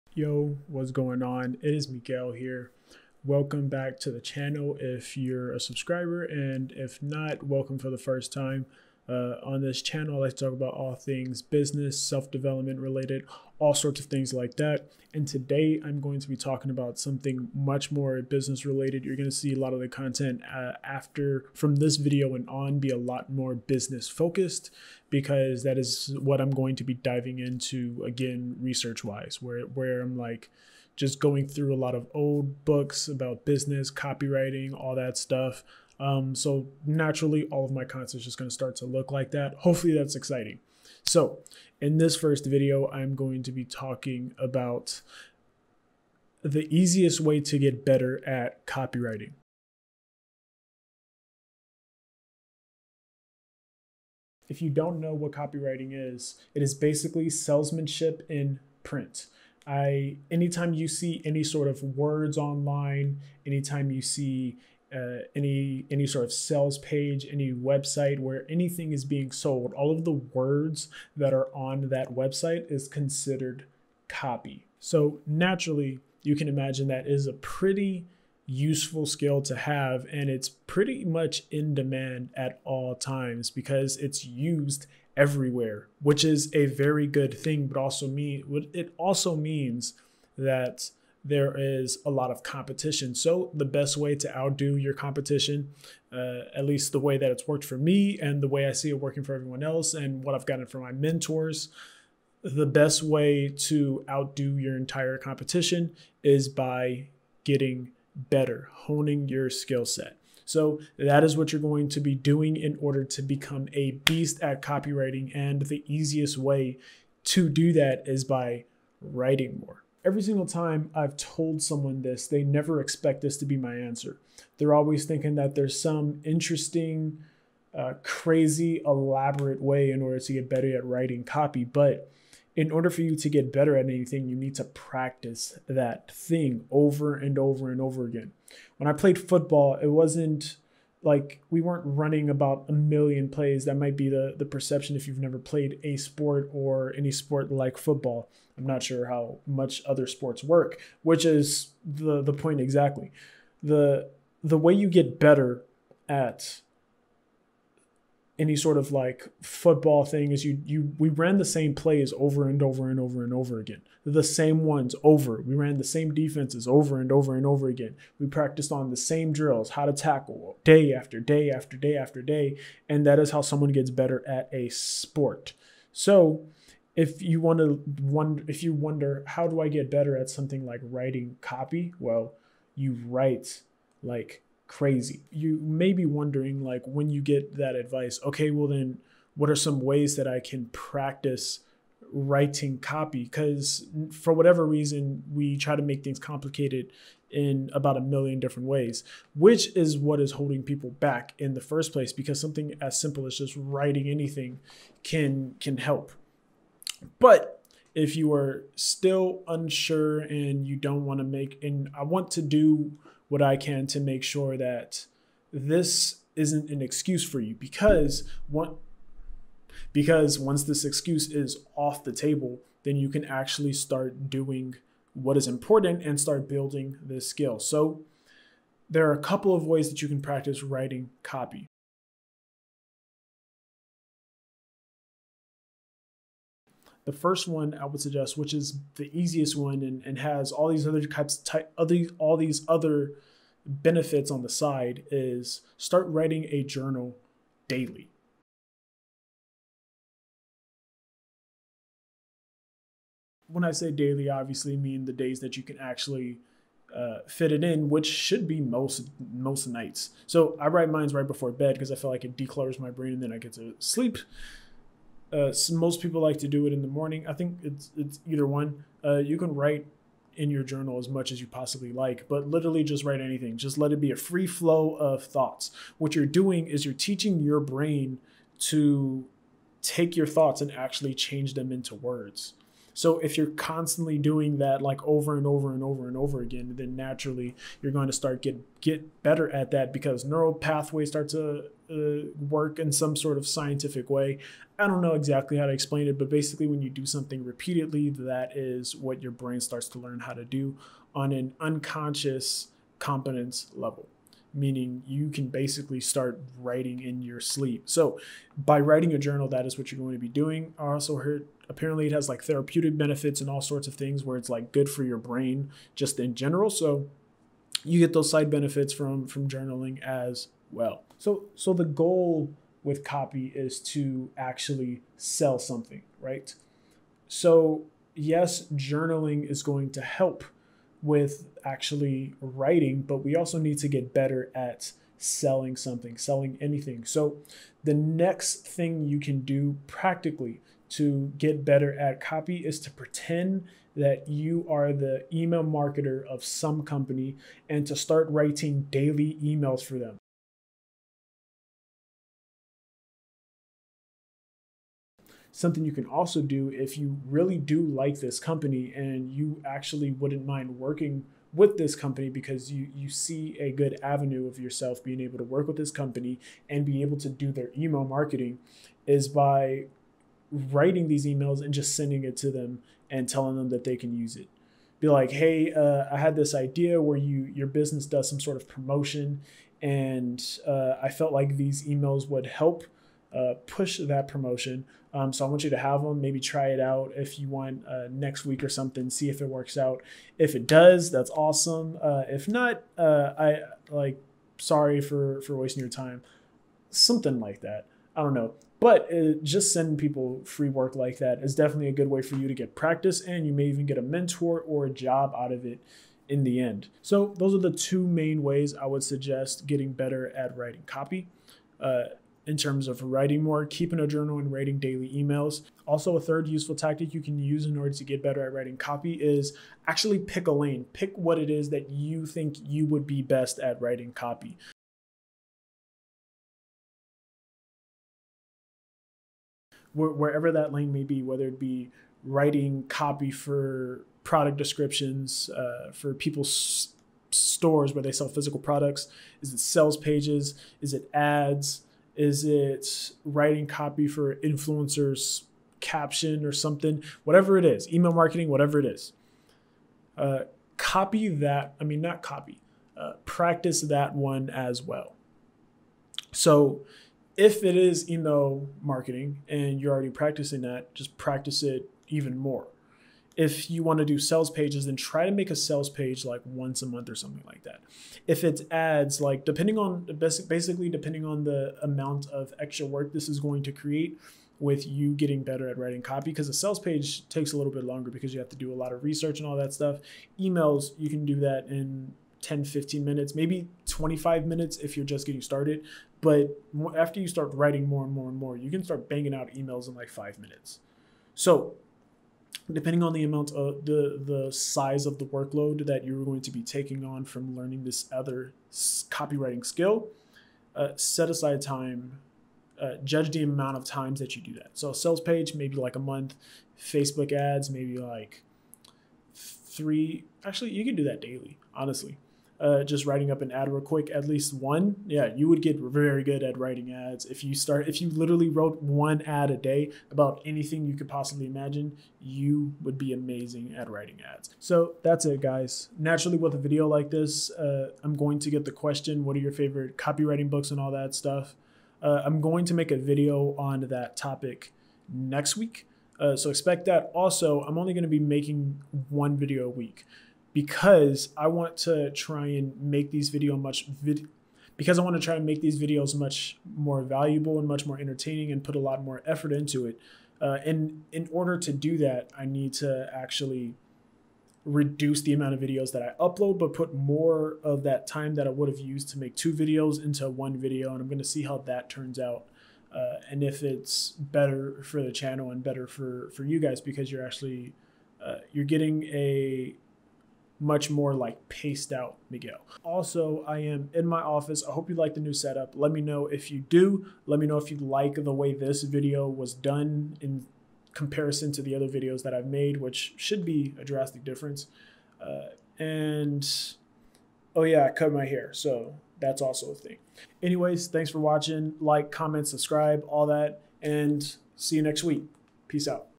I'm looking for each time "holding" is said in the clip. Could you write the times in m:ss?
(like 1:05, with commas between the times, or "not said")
3:20.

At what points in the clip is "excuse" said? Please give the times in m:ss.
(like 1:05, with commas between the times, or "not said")
3:36, 3:40.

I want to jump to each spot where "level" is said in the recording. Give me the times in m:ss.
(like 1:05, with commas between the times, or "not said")
5:03.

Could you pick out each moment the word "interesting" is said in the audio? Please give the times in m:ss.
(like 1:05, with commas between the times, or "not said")
2:06.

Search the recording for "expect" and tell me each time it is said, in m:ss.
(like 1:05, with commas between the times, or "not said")
2:02, 8:56.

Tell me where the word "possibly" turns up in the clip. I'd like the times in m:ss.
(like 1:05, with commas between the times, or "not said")
4:31, 8:41.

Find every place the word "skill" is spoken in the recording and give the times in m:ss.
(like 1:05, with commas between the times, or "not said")
1:19, 1:49, 3:47, 8:19.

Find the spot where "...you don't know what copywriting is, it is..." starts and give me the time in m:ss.
0:54.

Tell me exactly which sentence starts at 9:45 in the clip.
Uh, and oh yeah, I cut my hair.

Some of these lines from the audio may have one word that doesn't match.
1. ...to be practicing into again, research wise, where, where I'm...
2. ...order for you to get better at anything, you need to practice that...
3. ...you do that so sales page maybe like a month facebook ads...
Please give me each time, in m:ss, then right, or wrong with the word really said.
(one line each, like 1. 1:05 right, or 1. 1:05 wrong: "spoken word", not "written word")
1. 0:26 wrong: "diving", not "practicing"
2. 2:12 right
3. 8:24 right.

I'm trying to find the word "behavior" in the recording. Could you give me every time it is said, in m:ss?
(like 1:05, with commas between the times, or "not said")
not said.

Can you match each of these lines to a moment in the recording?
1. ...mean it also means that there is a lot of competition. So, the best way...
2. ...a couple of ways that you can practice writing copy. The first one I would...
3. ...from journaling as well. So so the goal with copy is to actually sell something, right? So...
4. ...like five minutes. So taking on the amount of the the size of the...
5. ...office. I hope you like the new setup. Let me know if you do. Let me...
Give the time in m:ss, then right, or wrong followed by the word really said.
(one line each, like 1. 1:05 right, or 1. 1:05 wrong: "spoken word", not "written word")
1. 1:28 right
2. 3:49 right
3. 5:19 right
4. 8:09 wrong: "depending", not "taking"
5. 9:34 right.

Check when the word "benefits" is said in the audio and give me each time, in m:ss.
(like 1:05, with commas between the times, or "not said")
4:03, 5:12, 5:18.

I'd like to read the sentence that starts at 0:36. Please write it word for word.
Um, so naturally, all of my content is just going to start to look like that.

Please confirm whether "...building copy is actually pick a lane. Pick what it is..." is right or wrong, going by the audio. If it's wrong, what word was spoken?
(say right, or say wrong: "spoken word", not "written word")
wrong: "writing", not "building".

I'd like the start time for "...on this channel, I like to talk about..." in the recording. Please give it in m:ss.
0:09.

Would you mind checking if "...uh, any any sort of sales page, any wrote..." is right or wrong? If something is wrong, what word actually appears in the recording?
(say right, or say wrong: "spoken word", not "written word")
wrong: "website", not "wrote".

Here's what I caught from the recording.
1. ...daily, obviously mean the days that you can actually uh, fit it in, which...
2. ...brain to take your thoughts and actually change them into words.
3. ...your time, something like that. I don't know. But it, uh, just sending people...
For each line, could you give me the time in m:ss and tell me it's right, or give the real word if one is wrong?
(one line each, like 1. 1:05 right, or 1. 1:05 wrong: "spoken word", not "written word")
1. 4:13 right
2. 4:37 right
3. 6:35 right.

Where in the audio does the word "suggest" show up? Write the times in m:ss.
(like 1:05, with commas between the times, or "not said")
3:57, 6:49.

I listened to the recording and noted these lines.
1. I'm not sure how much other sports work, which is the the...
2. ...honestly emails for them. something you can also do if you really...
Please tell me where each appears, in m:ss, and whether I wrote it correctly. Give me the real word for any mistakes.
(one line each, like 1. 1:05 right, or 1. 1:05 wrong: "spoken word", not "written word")
1. 2:28 right
2. 5:48 wrong: "daily", not "honestly".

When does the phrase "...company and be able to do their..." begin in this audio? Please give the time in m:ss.
6:05.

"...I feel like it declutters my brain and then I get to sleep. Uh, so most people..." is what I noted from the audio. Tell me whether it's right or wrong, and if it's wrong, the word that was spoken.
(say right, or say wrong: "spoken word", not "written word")
right.